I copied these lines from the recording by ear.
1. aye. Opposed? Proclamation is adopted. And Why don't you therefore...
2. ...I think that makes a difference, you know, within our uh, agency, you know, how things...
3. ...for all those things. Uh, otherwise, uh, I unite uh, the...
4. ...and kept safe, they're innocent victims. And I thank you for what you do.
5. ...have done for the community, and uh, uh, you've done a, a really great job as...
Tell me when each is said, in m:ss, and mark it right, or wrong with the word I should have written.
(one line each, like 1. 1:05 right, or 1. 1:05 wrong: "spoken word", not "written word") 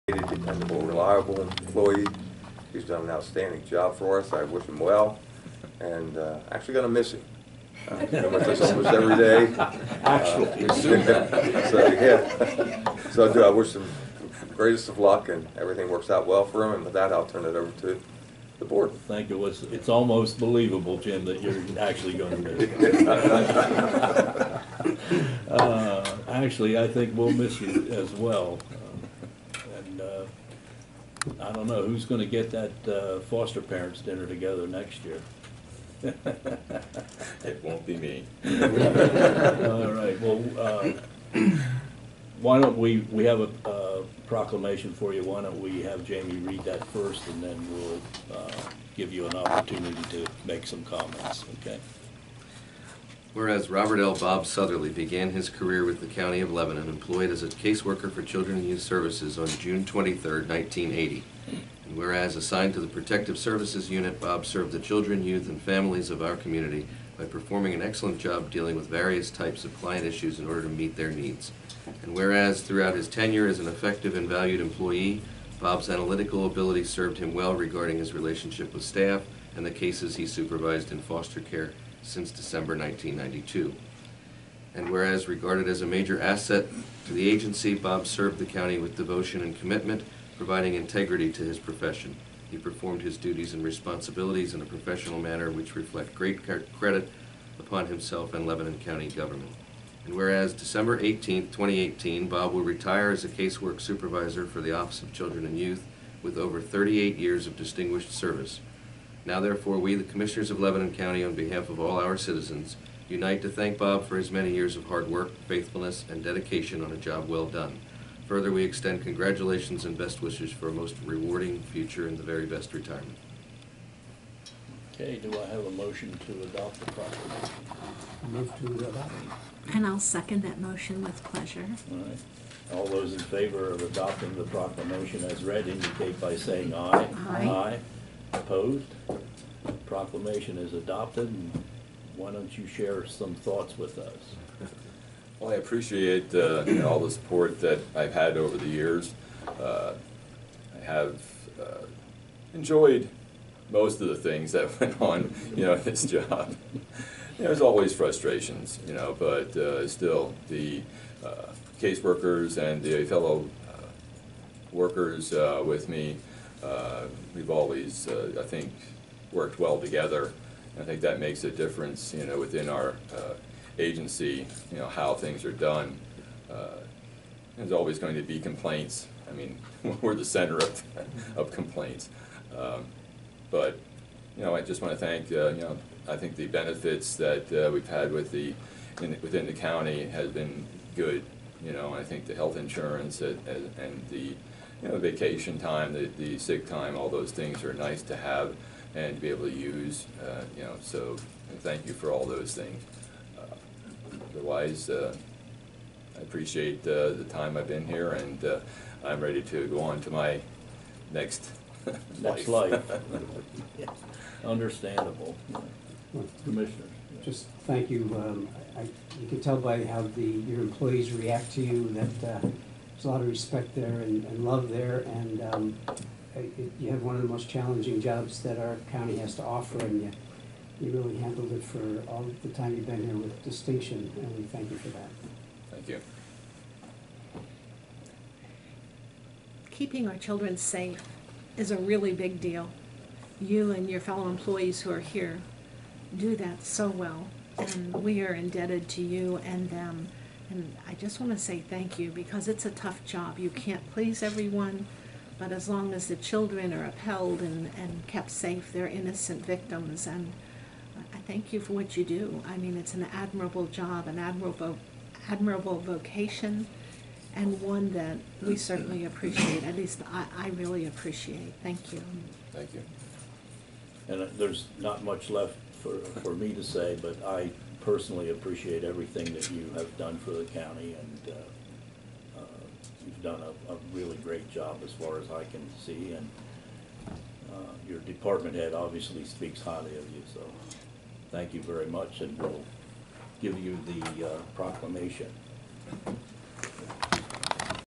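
1. 2:17 wrong: "share", not "therefore"
2. 2:50 right
3. 3:21 wrong: "appreciate", not "unite"
4. 4:17 right
5. 4:39 wrong: "county", not "community".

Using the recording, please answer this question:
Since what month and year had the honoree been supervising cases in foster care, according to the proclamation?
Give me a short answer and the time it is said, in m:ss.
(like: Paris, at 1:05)
December 1992, at 1:22.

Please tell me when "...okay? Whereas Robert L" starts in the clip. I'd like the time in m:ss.
0:51.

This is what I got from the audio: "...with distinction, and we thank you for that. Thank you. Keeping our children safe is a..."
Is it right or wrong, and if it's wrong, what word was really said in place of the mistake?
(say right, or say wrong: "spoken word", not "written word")
right.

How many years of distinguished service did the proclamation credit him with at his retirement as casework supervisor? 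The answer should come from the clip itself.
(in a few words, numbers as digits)
38.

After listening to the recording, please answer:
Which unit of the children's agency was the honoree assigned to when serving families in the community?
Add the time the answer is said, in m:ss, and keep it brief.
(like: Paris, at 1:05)
Protective Services Unit, at 1:02.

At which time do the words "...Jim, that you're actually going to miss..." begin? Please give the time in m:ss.
0:20.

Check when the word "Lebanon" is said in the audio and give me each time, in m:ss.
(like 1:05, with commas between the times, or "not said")
0:56, 1:38, 1:50.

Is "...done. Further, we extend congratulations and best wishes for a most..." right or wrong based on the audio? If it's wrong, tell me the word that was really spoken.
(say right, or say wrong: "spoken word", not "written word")
right.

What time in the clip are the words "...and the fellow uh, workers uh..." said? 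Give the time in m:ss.
2:42.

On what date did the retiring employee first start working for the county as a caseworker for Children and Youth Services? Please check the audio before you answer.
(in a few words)
June 23, 1980.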